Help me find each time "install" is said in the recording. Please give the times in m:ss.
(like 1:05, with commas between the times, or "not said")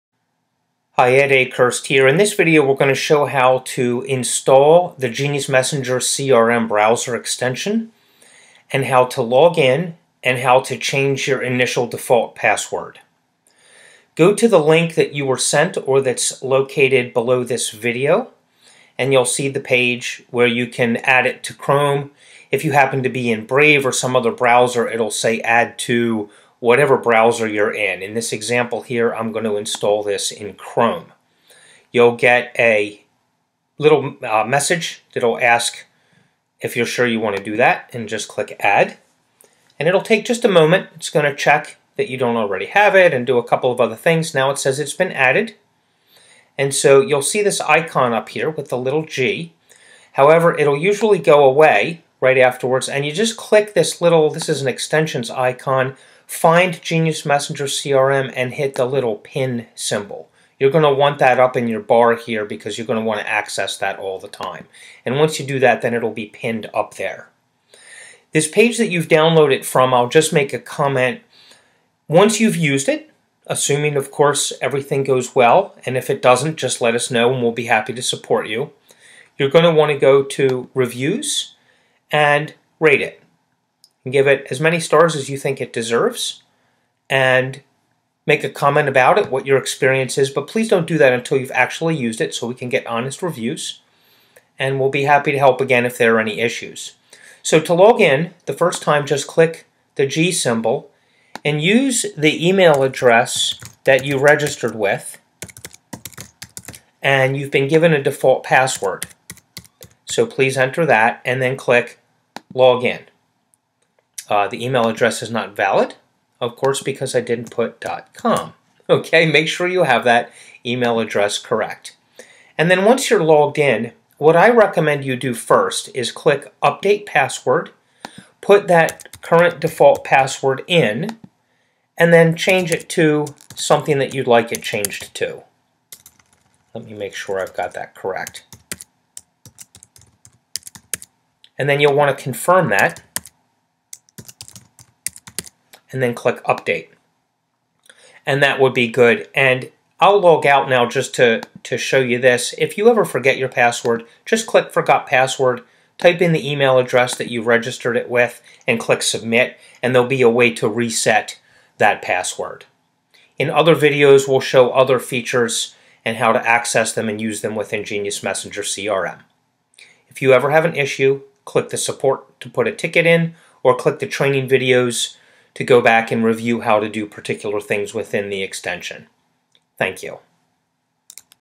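0:04, 0:29.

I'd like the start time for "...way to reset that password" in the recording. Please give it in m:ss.
2:40.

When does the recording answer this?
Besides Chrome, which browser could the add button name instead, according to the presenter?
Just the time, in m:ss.
0:23.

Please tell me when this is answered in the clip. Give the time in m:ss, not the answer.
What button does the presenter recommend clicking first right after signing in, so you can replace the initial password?
2:06.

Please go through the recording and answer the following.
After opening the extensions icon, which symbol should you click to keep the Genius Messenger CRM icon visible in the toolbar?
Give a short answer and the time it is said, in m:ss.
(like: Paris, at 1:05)
pin symbol, at 0:59.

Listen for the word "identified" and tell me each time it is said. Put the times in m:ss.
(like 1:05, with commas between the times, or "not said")
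not said.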